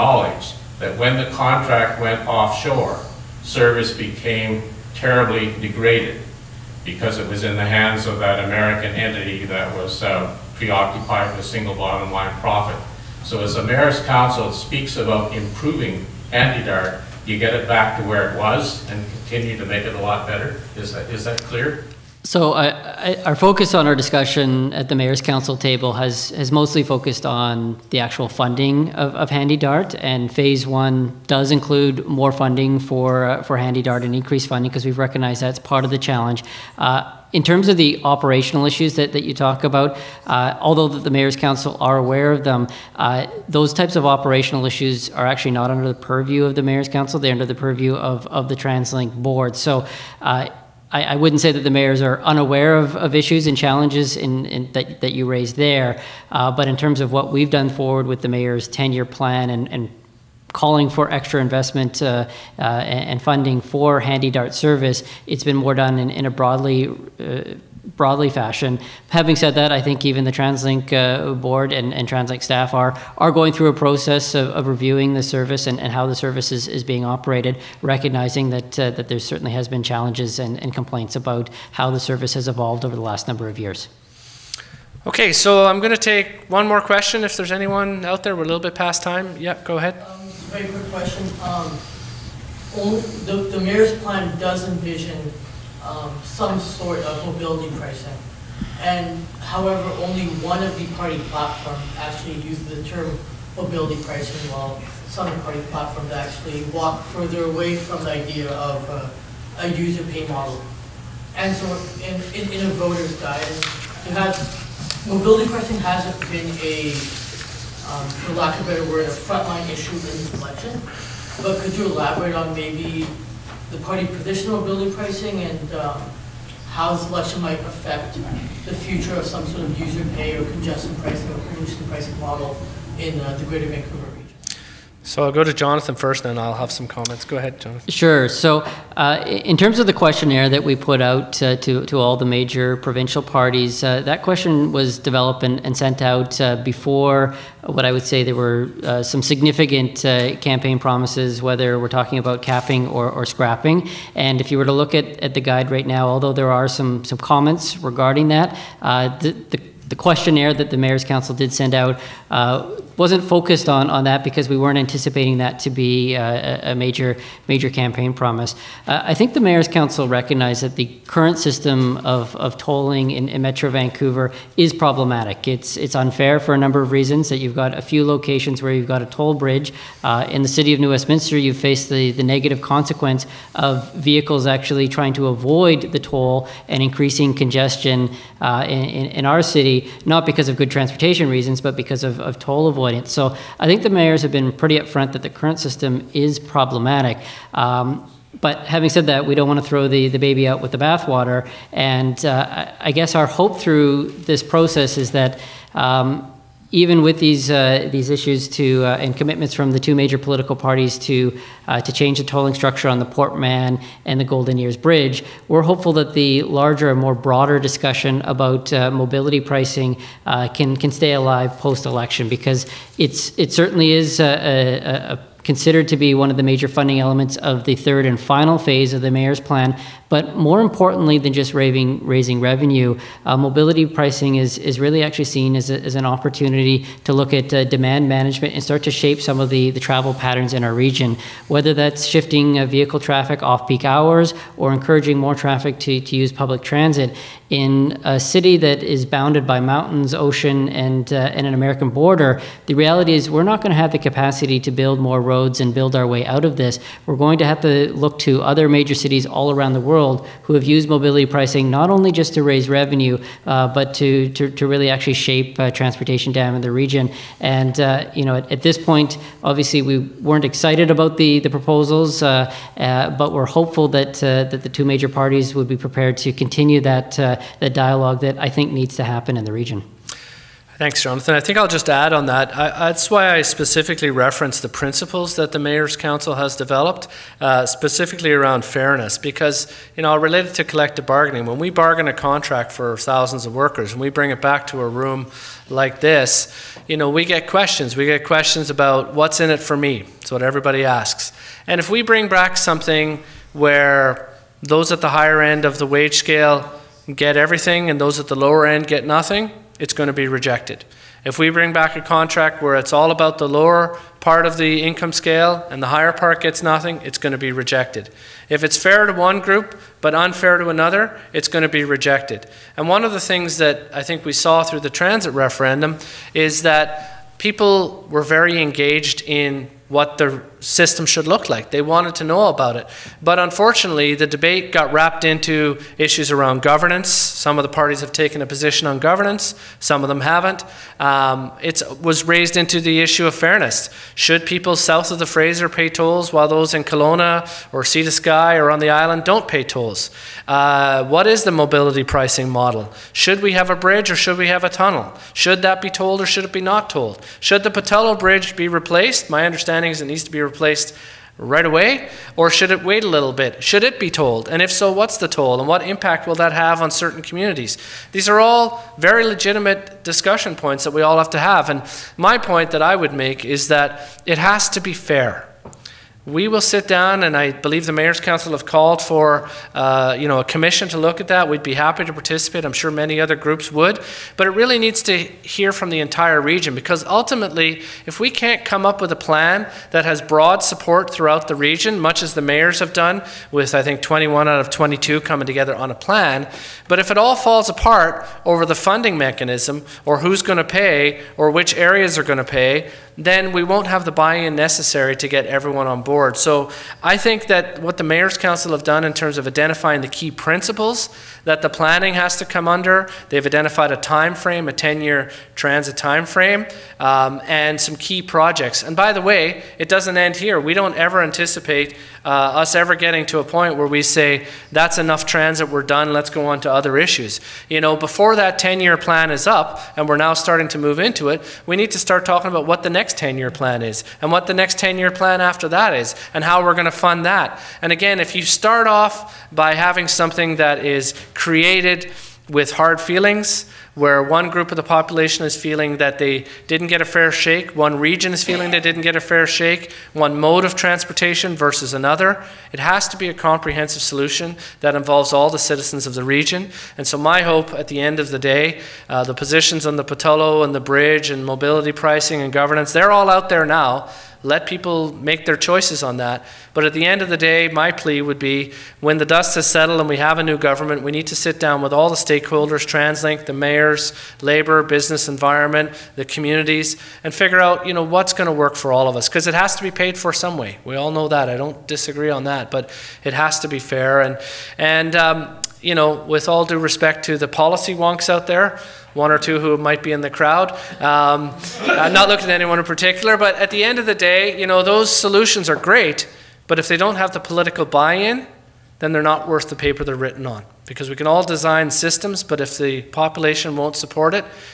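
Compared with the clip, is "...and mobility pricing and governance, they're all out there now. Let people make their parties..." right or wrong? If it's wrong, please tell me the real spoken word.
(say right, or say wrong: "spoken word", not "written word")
wrong: "choices", not "parties".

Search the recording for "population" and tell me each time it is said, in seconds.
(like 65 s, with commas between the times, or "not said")
444 s, 503 s.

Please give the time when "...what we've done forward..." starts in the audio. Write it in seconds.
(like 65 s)
57 s.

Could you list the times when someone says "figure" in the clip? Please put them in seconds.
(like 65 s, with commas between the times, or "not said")
477 s.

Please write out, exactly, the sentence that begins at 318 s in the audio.
If it's fair to one group but unfair to another, it's going to be rejected.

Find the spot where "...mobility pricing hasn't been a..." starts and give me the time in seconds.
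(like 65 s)
115 s.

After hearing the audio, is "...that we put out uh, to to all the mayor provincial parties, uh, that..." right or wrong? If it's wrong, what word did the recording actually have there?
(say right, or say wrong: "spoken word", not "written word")
wrong: "major", not "mayor".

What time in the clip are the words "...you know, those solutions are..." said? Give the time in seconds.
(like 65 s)
494 s.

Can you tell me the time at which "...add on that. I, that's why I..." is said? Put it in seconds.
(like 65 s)
281 s.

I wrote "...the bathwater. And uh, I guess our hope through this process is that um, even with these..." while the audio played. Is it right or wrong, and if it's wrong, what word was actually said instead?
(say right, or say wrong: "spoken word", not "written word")
right.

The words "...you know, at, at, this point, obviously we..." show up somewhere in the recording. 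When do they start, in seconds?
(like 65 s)
268 s.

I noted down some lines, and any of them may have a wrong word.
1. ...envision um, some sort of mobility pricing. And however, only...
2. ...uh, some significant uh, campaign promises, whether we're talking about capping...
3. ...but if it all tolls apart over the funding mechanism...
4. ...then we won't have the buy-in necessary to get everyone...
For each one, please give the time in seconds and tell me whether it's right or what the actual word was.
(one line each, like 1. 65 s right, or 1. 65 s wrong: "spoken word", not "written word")
1. 94 s right
2. 148 s right
3. 396 s wrong: "falls", not "tolls"
4. 403 s right.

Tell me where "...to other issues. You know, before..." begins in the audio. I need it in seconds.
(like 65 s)
426 s.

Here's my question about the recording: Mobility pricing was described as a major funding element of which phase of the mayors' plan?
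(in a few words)
third and final phase.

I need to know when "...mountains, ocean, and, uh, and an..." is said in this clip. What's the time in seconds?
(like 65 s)
249 s.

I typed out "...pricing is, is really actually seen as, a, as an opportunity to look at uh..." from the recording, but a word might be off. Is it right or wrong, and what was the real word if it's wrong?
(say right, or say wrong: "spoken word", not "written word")
right.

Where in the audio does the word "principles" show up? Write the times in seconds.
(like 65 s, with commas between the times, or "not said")
284 s, 410 s.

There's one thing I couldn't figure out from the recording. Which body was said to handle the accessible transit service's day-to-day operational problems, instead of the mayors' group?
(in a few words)
TransLink Board.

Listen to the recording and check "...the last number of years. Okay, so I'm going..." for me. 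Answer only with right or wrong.
right.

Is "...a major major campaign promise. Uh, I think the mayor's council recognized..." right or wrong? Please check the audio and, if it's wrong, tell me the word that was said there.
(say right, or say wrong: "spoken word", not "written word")
right.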